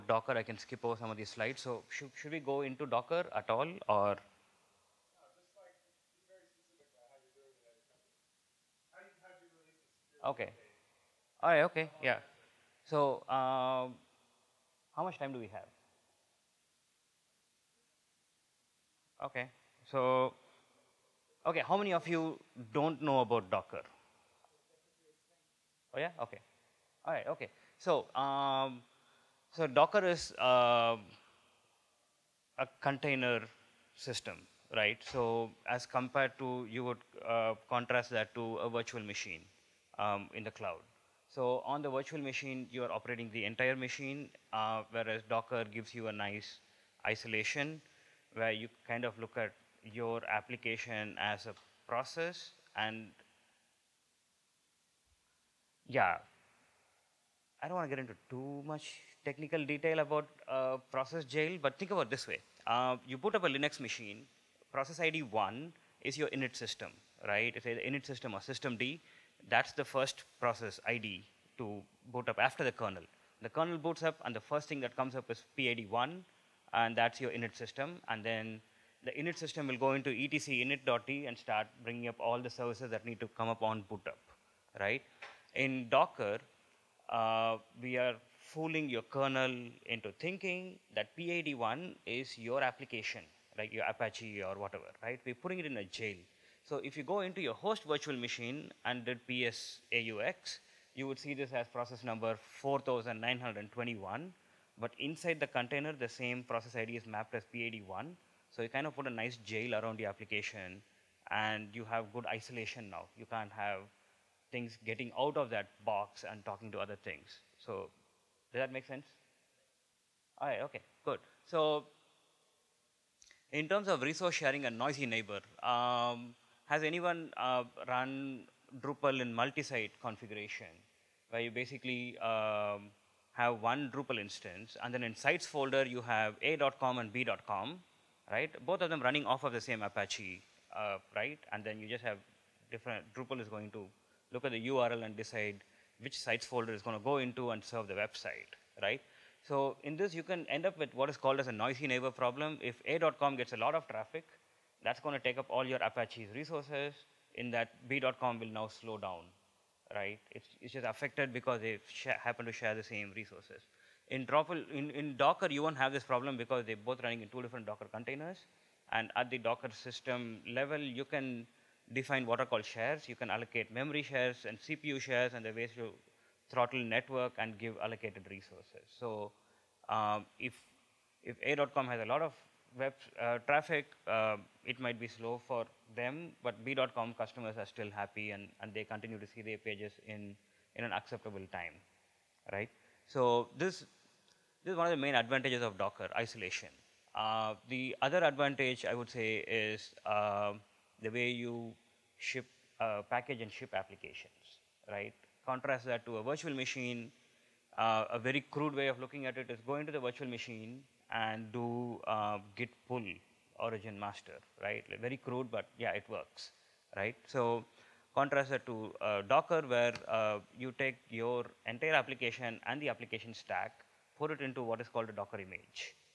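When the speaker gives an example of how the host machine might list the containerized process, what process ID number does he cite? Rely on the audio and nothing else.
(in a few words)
4921.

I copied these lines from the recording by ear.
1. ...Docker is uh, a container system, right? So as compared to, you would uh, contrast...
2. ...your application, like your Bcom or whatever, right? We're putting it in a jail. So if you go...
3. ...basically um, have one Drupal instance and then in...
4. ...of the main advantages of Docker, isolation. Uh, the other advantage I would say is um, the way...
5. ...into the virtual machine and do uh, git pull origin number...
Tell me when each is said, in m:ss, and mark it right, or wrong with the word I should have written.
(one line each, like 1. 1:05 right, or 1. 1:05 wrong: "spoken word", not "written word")
1. 0:29 right
2. 1:32 wrong: "Apache", not "Bcom"
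3. 2:11 right
4. 3:14 right
5. 3:29 wrong: "master", not "number".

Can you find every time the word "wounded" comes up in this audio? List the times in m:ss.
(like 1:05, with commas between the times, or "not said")
not said.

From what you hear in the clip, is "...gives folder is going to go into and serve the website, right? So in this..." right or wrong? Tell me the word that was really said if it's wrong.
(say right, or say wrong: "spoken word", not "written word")
wrong: "sites", not "gives".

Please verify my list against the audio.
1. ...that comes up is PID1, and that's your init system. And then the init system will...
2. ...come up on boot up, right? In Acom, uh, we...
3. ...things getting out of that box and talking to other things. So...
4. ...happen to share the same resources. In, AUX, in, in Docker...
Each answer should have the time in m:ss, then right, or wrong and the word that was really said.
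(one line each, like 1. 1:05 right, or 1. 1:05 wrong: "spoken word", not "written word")
1. 1:14 right
2. 1:23 wrong: "Docker", not "Acom"
3. 1:54 right
4. 2:42 wrong: "Drupal", not "AUX".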